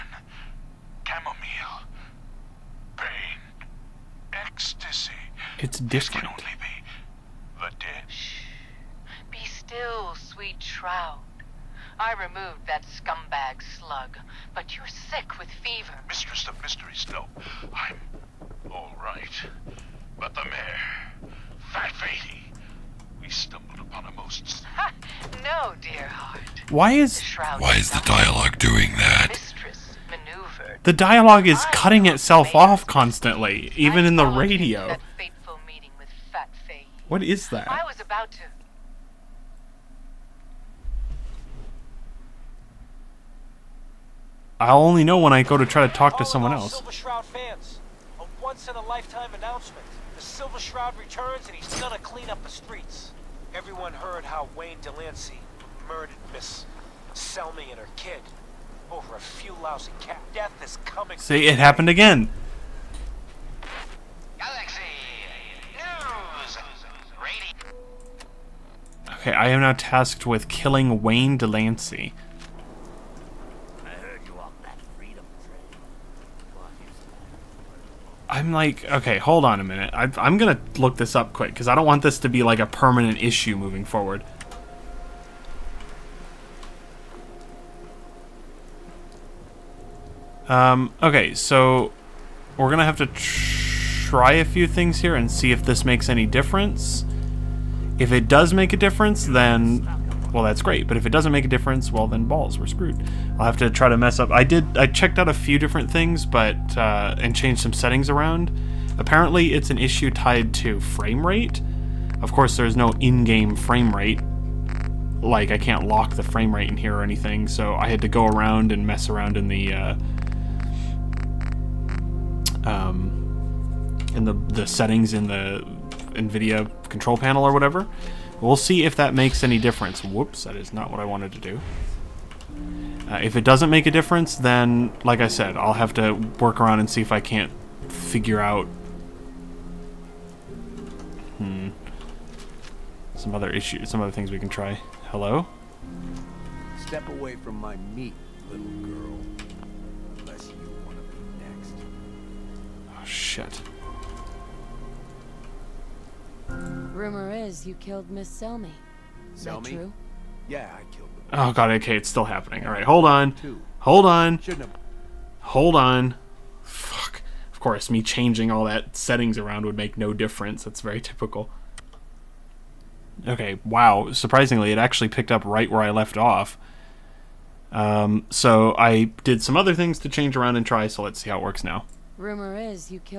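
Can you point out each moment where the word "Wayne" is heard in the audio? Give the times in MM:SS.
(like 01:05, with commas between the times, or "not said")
00:54, 01:11.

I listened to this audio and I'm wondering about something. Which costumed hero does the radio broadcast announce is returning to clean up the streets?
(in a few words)
The Silver Shroud.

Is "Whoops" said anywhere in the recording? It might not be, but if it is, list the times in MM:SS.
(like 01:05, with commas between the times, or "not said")
02:10.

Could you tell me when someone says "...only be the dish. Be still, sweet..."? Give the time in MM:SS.
00:06.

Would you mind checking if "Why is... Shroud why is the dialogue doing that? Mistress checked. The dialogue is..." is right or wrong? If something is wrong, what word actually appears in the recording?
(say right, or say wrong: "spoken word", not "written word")
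wrong: "maneuvered", not "checked".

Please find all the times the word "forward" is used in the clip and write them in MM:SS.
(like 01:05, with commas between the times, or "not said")
01:23.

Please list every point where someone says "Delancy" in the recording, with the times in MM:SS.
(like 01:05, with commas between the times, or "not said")
00:54, 01:11.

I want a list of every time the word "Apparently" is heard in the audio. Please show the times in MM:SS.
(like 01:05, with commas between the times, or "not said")
01:48.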